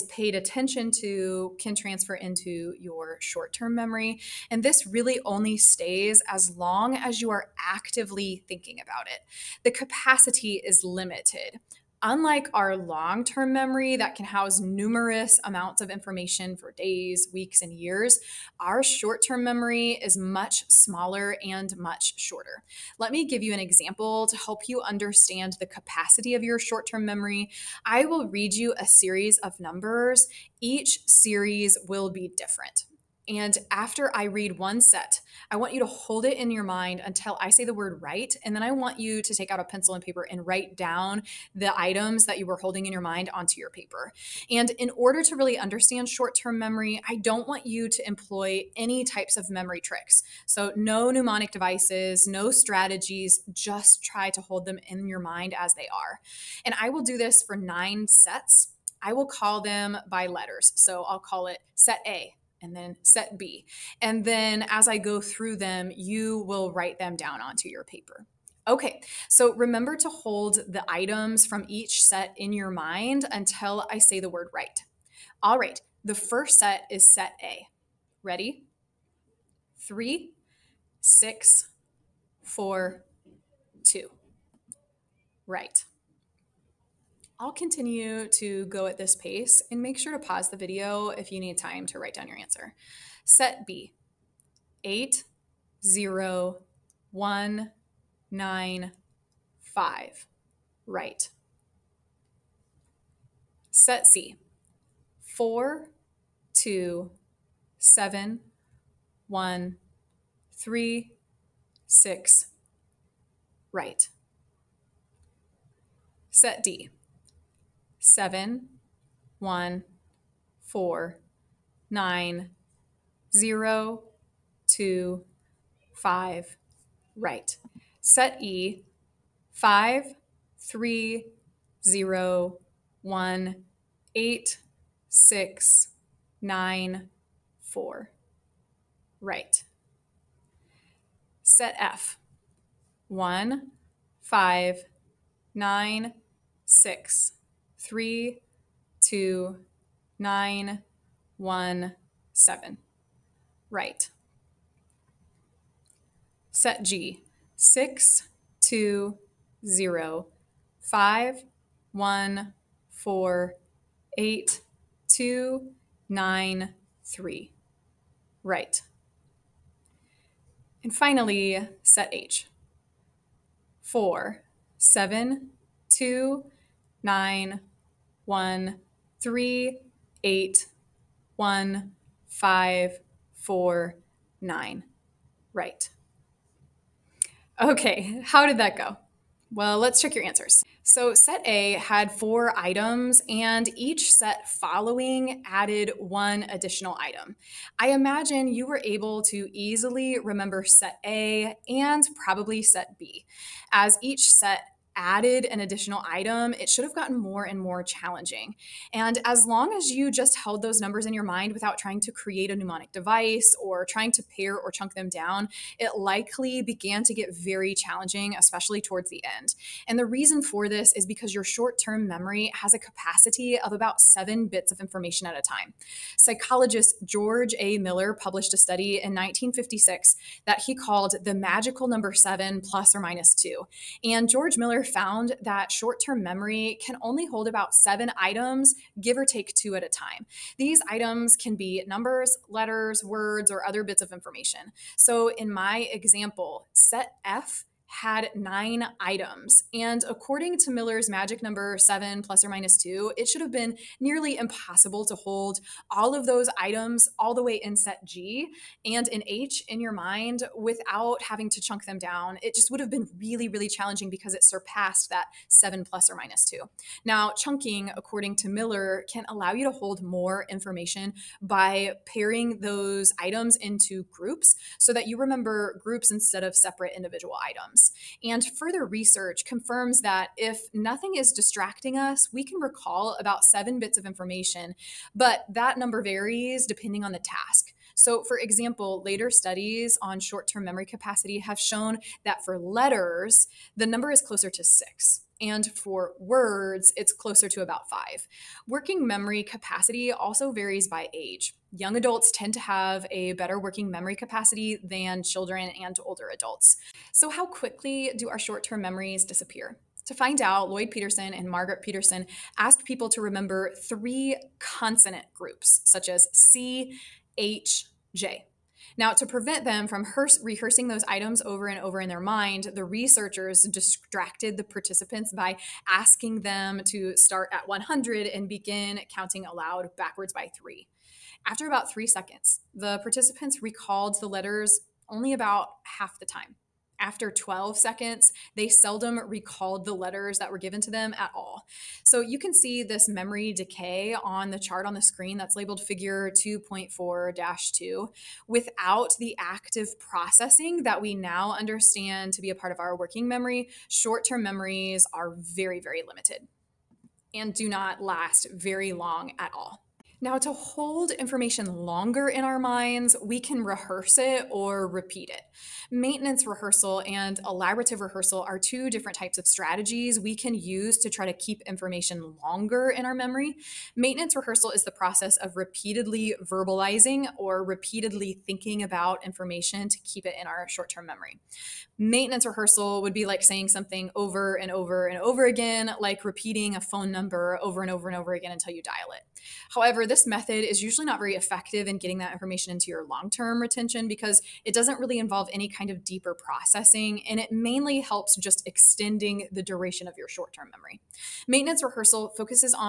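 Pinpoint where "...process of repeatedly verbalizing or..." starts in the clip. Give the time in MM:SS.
06:14.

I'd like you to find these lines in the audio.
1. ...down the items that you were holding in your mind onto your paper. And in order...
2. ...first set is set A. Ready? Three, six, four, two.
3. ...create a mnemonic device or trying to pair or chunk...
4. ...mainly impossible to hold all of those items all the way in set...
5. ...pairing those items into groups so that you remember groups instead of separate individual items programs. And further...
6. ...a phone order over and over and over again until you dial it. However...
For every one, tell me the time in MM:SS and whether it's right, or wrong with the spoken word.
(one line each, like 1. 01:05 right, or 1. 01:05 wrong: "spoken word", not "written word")
1. 00:40 right
2. 01:16 right
3. 03:32 right
4. 04:13 wrong: "nearly", not "mainly"
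5. 04:32 right
6. 06:26 wrong: "number", not "order".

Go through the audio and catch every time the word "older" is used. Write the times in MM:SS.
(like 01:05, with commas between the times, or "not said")
05:06.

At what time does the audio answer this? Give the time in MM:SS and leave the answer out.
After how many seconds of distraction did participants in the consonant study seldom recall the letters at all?
05:37.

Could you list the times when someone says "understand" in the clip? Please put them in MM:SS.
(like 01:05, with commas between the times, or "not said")
00:24, 00:45, 05:51.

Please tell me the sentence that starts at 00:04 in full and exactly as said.
And this really only stays as long as you are actively thinking about it.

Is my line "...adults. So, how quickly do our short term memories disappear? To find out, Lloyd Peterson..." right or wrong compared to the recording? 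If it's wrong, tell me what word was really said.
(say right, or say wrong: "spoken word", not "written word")
right.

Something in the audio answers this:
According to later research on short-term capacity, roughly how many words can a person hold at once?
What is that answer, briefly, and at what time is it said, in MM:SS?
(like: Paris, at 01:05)
5, at 04:57.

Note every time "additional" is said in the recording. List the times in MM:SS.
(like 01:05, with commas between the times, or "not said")
03:16, 03:25.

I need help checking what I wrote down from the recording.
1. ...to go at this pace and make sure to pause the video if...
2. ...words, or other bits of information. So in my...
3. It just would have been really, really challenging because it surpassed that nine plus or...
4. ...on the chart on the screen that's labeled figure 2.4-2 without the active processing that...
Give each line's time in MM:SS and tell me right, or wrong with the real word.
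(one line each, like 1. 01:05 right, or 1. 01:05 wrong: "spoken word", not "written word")
1. 01:28 right
2. 04:03 right
3. 04:22 wrong: "seven", not "nine"
4. 05:44 right.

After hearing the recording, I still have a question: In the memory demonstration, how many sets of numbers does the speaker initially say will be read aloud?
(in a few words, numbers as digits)
9.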